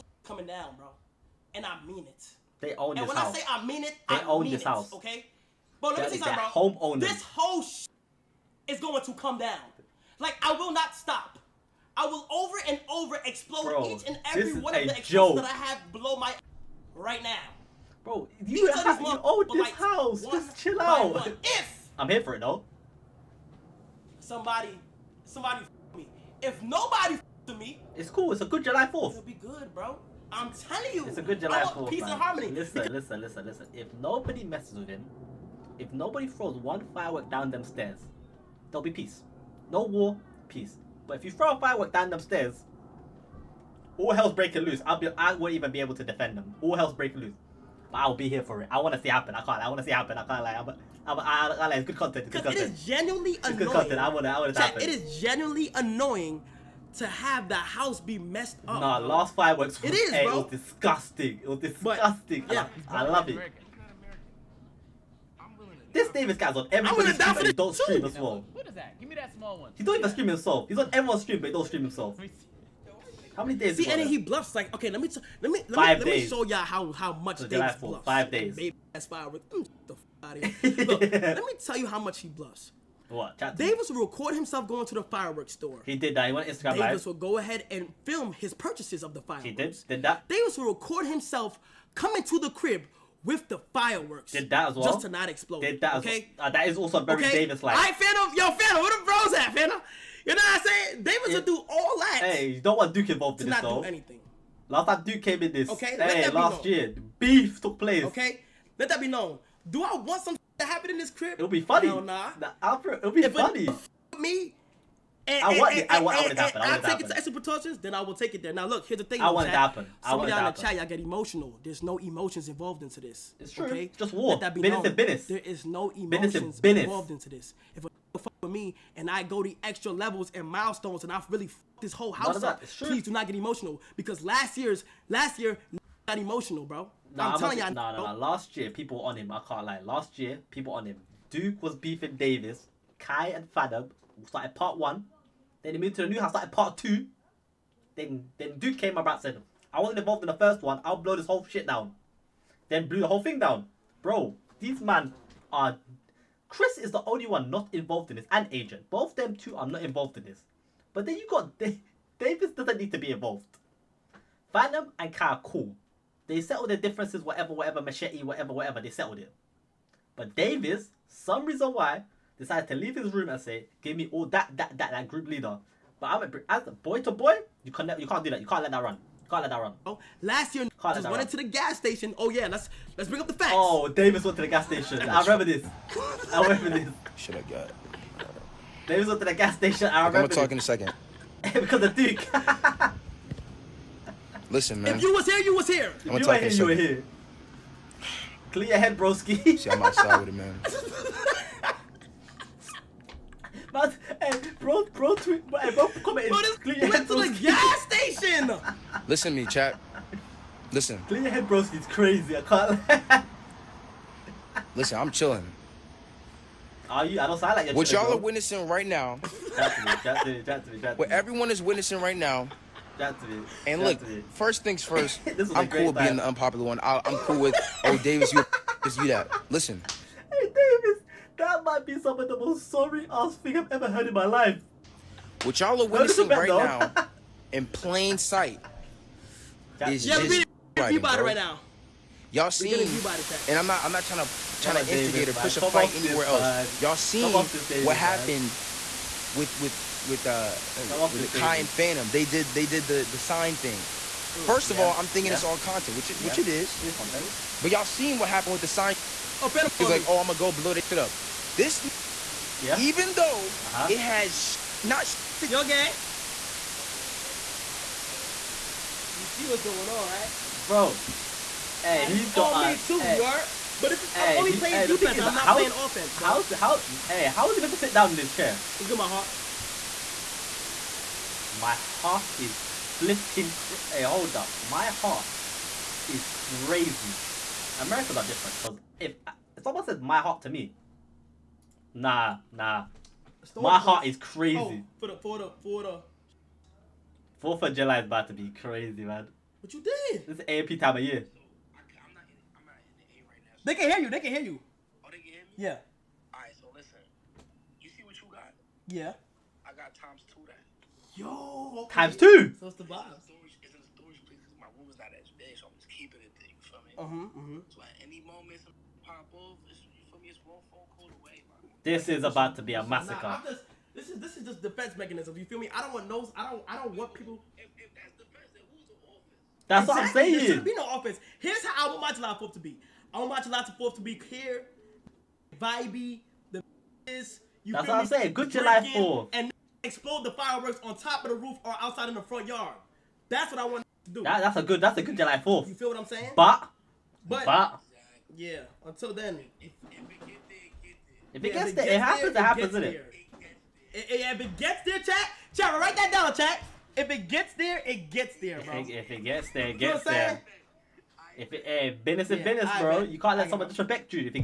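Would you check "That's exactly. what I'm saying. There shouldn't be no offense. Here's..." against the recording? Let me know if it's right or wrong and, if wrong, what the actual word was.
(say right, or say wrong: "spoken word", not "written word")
right.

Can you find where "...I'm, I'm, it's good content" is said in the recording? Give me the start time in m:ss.
0:51.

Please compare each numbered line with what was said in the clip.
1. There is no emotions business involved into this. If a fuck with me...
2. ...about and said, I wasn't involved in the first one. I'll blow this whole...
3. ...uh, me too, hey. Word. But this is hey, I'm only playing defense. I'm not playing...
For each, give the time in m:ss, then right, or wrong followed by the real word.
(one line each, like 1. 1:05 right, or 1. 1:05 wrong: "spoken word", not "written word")
1. 2:05 right
2. 2:28 right
3. 4:32 right.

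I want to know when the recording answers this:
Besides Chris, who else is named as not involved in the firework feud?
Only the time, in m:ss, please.
2:38.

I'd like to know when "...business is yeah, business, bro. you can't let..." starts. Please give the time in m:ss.
6:02.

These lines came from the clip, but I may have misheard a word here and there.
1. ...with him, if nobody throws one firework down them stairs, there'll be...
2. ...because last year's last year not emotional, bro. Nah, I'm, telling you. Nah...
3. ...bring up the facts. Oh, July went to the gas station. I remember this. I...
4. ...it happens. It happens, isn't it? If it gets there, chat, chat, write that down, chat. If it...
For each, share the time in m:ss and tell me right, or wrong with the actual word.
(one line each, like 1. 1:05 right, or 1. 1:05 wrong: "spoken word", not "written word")
1. 0:34 right
2. 2:13 right
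3. 3:03 wrong: "Davis", not "July"
4. 5:51 right.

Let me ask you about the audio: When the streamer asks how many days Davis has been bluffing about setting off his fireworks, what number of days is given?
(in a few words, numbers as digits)
5 days.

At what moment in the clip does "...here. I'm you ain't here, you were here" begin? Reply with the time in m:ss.
3:15.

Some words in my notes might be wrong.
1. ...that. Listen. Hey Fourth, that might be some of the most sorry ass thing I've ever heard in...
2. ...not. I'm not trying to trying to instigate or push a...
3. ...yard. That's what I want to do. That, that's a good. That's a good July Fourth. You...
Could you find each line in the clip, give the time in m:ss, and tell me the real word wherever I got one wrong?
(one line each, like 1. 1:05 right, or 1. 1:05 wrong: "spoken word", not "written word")
1. 3:49 wrong: "Davis", not "Fourth"
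2. 4:03 right
3. 5:42 right.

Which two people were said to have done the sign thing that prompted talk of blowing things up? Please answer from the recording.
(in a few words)
Kai and Fanum.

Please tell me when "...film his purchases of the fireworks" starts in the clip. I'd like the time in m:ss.
1:28.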